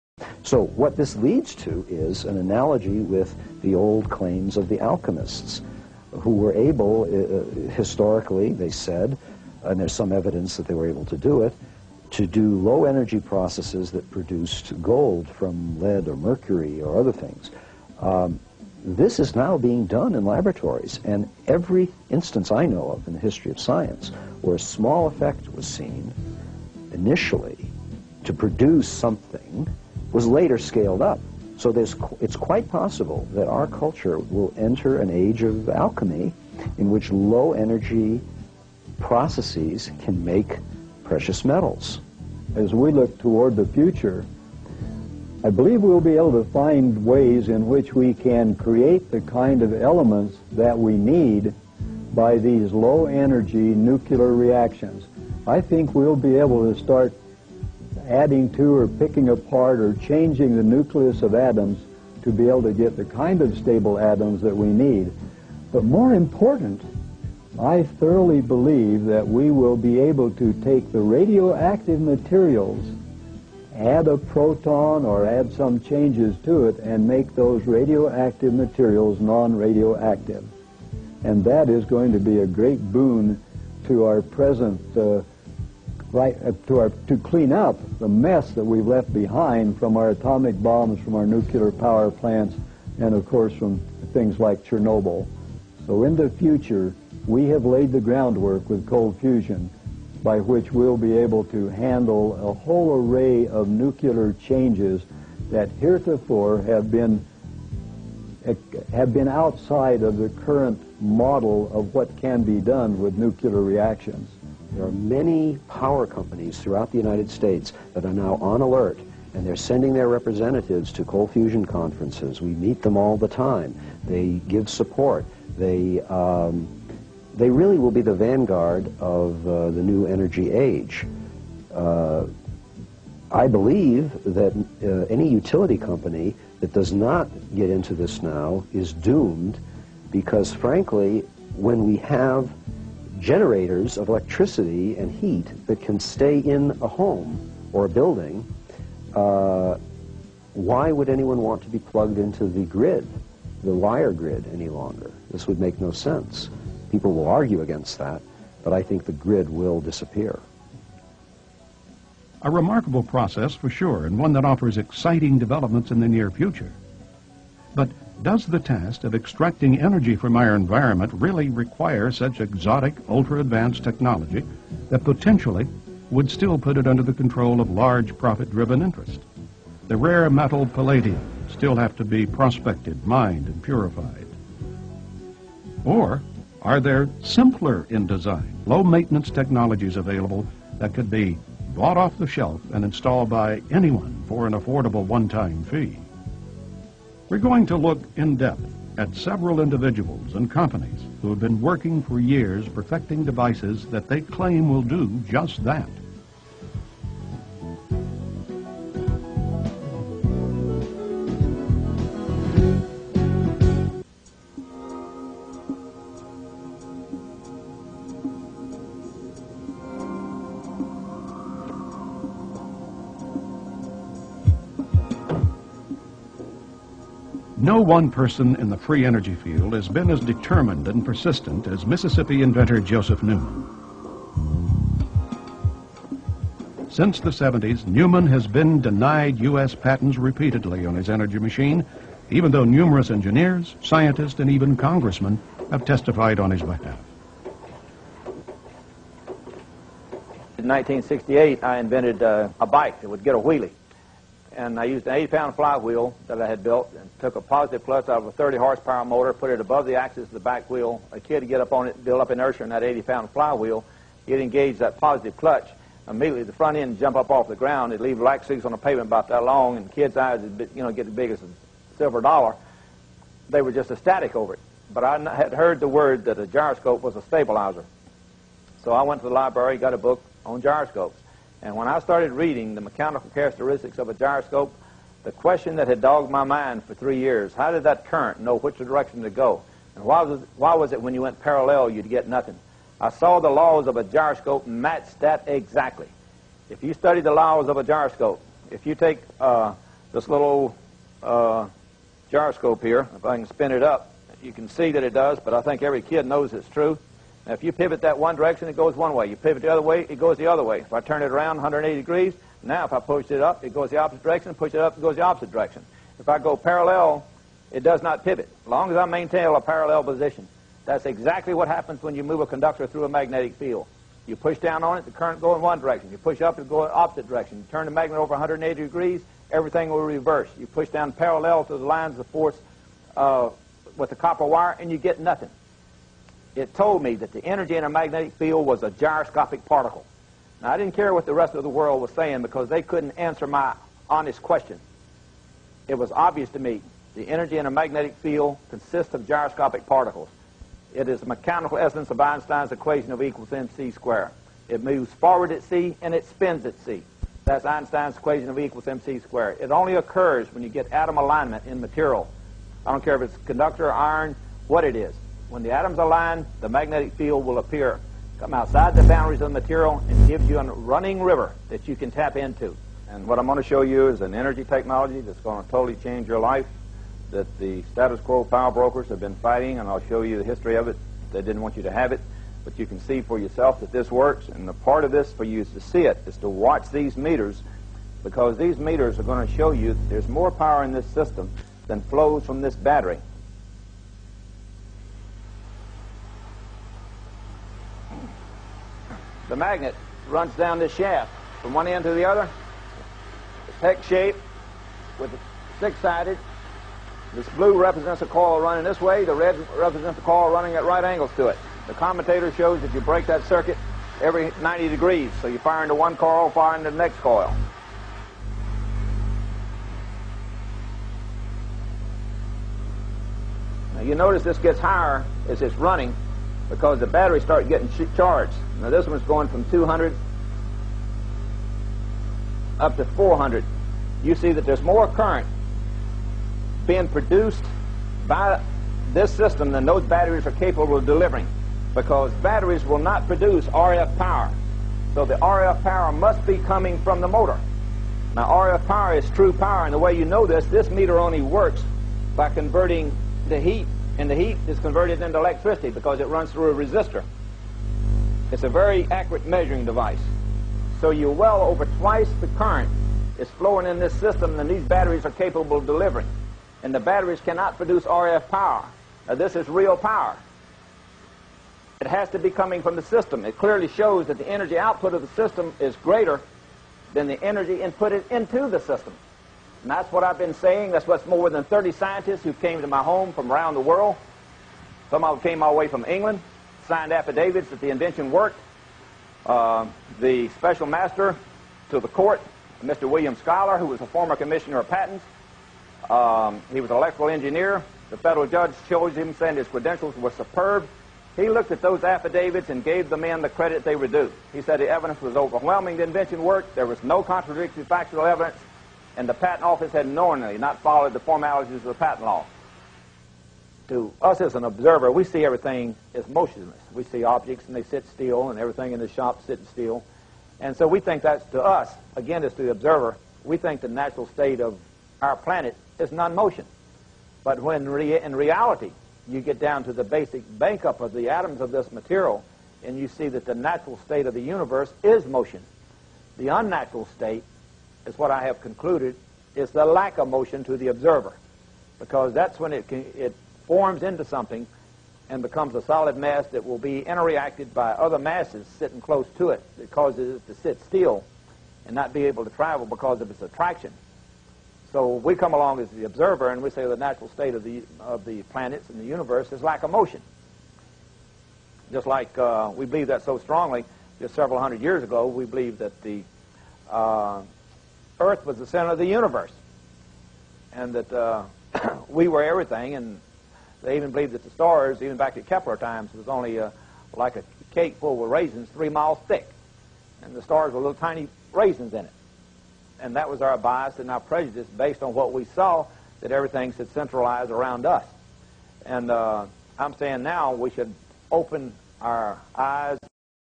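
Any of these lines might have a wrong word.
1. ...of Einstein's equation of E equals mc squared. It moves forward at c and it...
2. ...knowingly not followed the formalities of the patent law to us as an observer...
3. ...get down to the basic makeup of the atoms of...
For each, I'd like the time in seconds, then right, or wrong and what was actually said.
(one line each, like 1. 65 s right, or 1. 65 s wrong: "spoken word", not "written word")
1. 352 s right
2. 510 s right
3. 529 s right.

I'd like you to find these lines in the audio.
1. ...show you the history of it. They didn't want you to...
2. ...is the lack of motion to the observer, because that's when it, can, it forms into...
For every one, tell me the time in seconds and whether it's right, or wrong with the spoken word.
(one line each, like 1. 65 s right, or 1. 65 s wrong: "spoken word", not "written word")
1. 380 s right
2. 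539 s right.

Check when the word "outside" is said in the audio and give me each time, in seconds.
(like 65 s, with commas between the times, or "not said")
109 s, 368 s.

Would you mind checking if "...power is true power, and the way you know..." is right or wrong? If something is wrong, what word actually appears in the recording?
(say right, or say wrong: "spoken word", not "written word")
right.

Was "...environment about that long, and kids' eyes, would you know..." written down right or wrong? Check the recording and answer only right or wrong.
wrong.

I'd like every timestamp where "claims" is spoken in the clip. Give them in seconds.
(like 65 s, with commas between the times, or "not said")
4 s, 204 s.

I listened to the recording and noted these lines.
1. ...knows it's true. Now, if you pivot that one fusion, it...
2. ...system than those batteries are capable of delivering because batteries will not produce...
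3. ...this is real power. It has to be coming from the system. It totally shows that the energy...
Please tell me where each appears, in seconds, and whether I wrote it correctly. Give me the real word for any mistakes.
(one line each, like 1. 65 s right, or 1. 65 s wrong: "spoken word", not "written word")
1. 306 s wrong: "direction", not "fusion"
2. 439 s right
3. 469 s wrong: "clearly", not "totally".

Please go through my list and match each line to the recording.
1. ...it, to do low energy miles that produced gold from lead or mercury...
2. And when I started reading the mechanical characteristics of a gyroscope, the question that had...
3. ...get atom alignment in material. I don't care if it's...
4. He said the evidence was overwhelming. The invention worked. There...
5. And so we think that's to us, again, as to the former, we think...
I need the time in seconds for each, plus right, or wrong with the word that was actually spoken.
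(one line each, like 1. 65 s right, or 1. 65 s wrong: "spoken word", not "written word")
1. 11 s wrong: "processes", not "miles"
2. 281 s right
3. 360 s right
4. 504 s right
5. 520 s wrong: "observer", not "former".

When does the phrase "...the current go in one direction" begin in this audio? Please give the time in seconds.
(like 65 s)
325 s.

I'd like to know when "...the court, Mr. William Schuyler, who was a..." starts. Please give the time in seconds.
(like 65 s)
492 s.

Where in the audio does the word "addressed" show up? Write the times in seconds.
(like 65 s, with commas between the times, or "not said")
not said.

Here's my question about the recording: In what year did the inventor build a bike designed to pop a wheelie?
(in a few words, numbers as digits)
1968.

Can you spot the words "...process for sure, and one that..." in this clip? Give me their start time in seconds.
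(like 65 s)
163 s.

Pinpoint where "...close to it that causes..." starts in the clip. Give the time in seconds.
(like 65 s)
549 s.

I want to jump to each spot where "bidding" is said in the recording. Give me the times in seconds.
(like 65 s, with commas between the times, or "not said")
not said.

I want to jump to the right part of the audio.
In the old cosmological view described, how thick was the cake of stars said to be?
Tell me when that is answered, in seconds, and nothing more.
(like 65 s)
578 s.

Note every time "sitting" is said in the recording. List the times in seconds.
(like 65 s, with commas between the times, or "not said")
519 s, 548 s.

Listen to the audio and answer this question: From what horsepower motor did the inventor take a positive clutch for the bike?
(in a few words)
30 horsepower.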